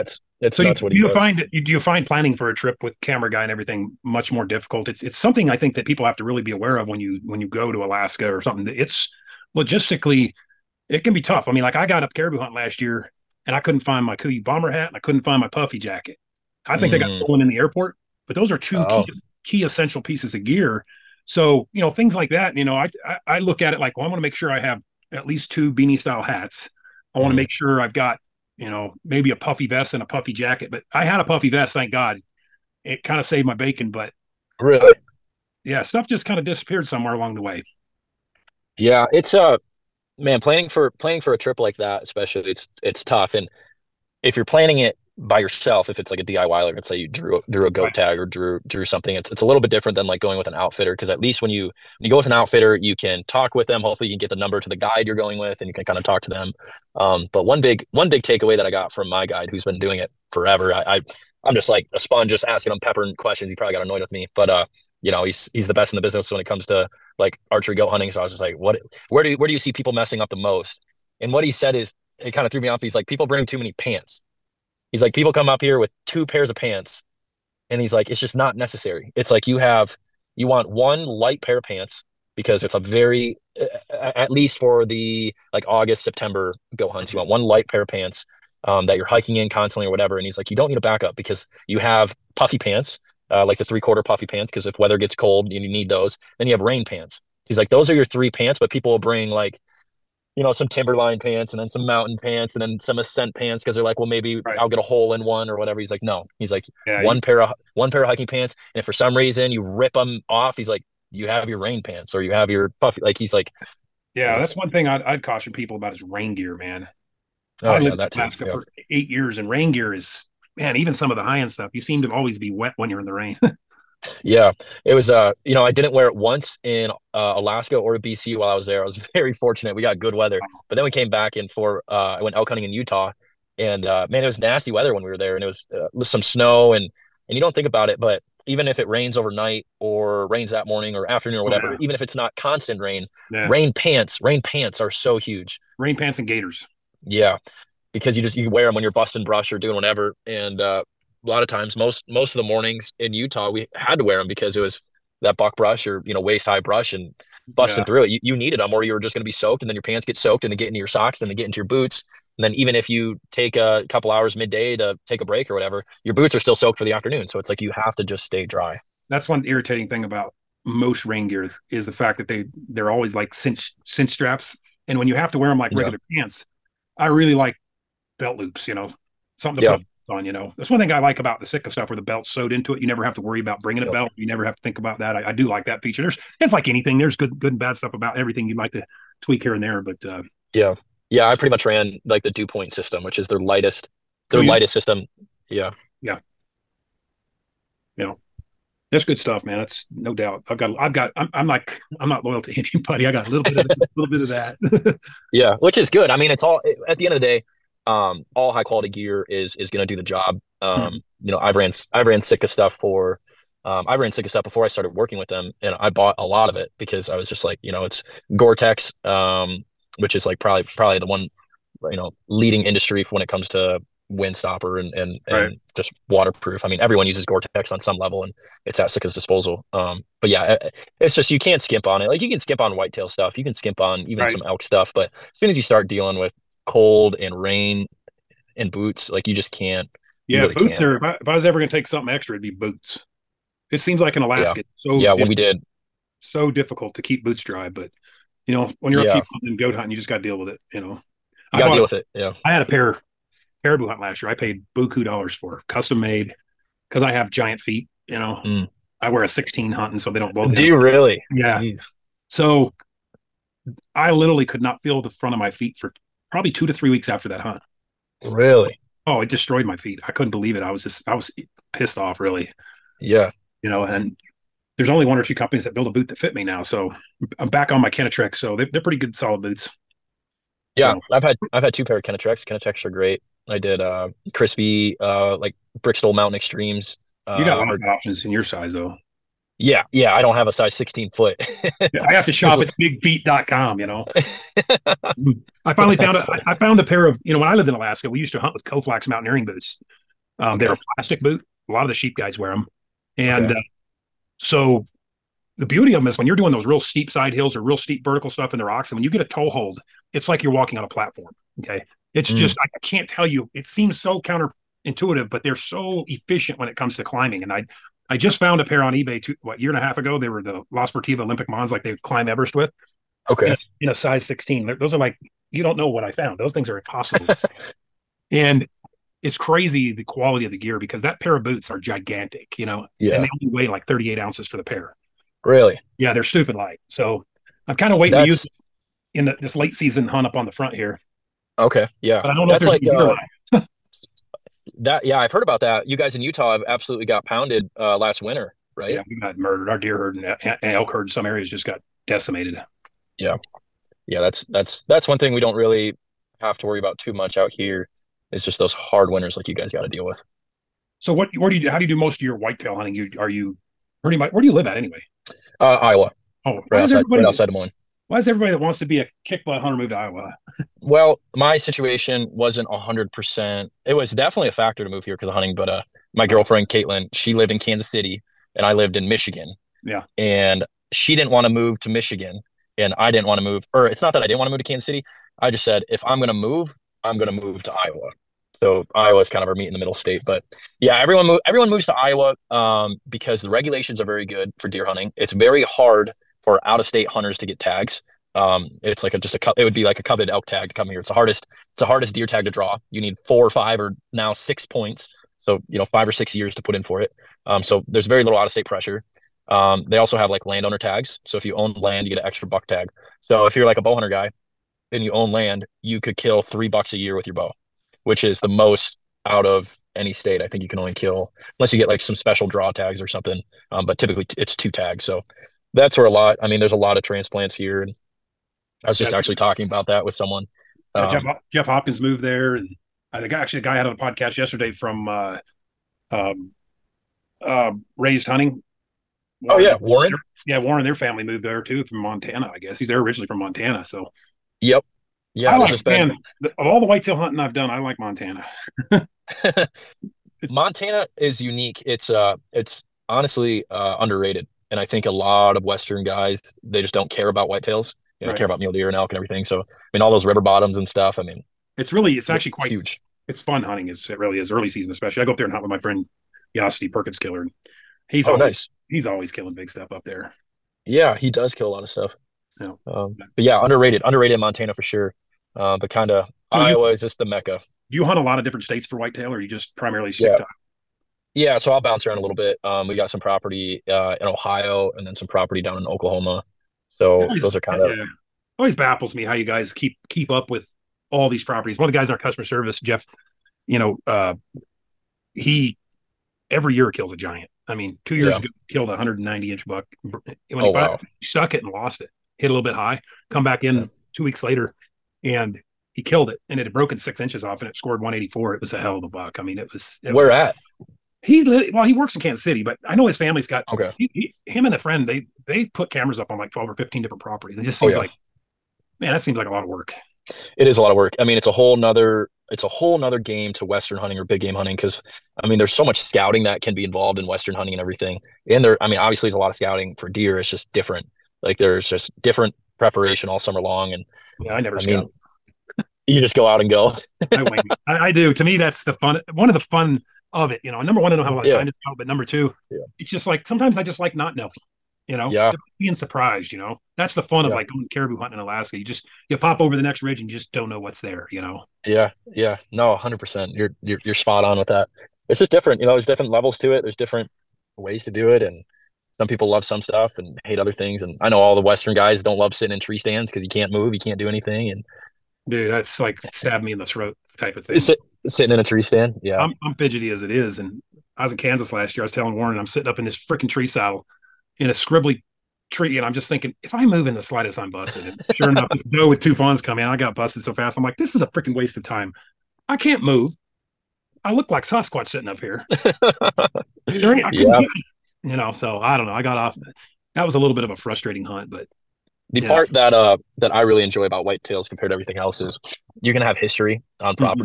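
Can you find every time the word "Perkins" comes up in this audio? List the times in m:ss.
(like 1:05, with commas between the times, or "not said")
7:46.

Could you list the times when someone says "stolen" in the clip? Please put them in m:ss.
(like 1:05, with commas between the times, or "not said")
0:17.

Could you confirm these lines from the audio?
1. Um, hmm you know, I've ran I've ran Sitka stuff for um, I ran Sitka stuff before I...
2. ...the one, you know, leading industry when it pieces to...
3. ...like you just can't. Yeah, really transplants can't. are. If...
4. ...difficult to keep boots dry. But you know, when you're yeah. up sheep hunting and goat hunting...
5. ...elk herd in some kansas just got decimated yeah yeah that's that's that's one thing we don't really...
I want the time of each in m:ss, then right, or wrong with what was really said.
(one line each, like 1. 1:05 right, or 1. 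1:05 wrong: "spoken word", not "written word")
1. 3:30 right
2. 3:40 wrong: "comes", not "pieces"
3. 3:59 wrong: "boots", not "transplants"
4. 4:06 right
5. 5:50 wrong: "areas", not "kansas".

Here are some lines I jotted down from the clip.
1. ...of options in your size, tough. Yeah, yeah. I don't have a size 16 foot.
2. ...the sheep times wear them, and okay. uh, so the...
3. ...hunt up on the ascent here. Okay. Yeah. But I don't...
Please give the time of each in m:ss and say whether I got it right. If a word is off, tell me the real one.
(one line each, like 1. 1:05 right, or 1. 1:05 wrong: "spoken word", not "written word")
1. 4:47 wrong: "though", not "tough"
2. 5:01 wrong: "guides", not "times"
3. 5:40 wrong: "front", not "ascent".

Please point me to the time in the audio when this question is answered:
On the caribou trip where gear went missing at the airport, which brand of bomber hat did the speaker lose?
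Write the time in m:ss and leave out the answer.
0:14.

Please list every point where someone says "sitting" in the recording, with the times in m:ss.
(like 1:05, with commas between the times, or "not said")
9:22, 9:28, 9:32, 9:45.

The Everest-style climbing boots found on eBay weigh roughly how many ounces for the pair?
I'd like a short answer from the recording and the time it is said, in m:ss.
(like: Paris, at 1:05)
38, at 5:33.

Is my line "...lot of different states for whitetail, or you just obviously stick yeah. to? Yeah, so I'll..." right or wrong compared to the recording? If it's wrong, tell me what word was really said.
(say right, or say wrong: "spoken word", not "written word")
wrong: "primarily", not "obviously".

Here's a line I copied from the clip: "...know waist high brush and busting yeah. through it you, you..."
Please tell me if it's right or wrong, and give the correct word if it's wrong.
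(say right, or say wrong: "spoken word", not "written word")
right.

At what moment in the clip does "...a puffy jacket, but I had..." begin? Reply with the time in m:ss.
0:30.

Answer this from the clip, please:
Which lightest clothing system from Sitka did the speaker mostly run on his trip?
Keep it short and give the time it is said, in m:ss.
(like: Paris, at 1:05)
Dew point, at 3:12.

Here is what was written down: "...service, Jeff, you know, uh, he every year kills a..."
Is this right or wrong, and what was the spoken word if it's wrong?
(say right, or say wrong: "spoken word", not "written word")
right.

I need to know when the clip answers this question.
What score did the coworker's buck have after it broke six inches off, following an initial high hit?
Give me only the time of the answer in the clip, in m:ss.
8:28.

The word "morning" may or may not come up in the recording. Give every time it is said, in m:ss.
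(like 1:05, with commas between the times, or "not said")
2:20, 2:32.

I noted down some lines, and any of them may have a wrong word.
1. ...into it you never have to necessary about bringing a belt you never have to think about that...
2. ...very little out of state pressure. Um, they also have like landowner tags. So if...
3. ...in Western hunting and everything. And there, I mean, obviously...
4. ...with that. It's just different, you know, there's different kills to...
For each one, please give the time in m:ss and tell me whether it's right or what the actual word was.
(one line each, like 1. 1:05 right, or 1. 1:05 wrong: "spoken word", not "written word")
1. 3:02 wrong: "worry", not "necessary"
2. 6:48 right
3. 8:47 right
4. 9:14 wrong: "levels", not "kills".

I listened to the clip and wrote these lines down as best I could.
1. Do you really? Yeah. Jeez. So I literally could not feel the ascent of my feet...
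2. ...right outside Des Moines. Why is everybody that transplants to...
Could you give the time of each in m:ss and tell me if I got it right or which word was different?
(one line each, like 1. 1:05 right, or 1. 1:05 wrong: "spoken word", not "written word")
1. 4:20 wrong: "front", not "ascent"
2. 6:07 wrong: "wants", not "transplants".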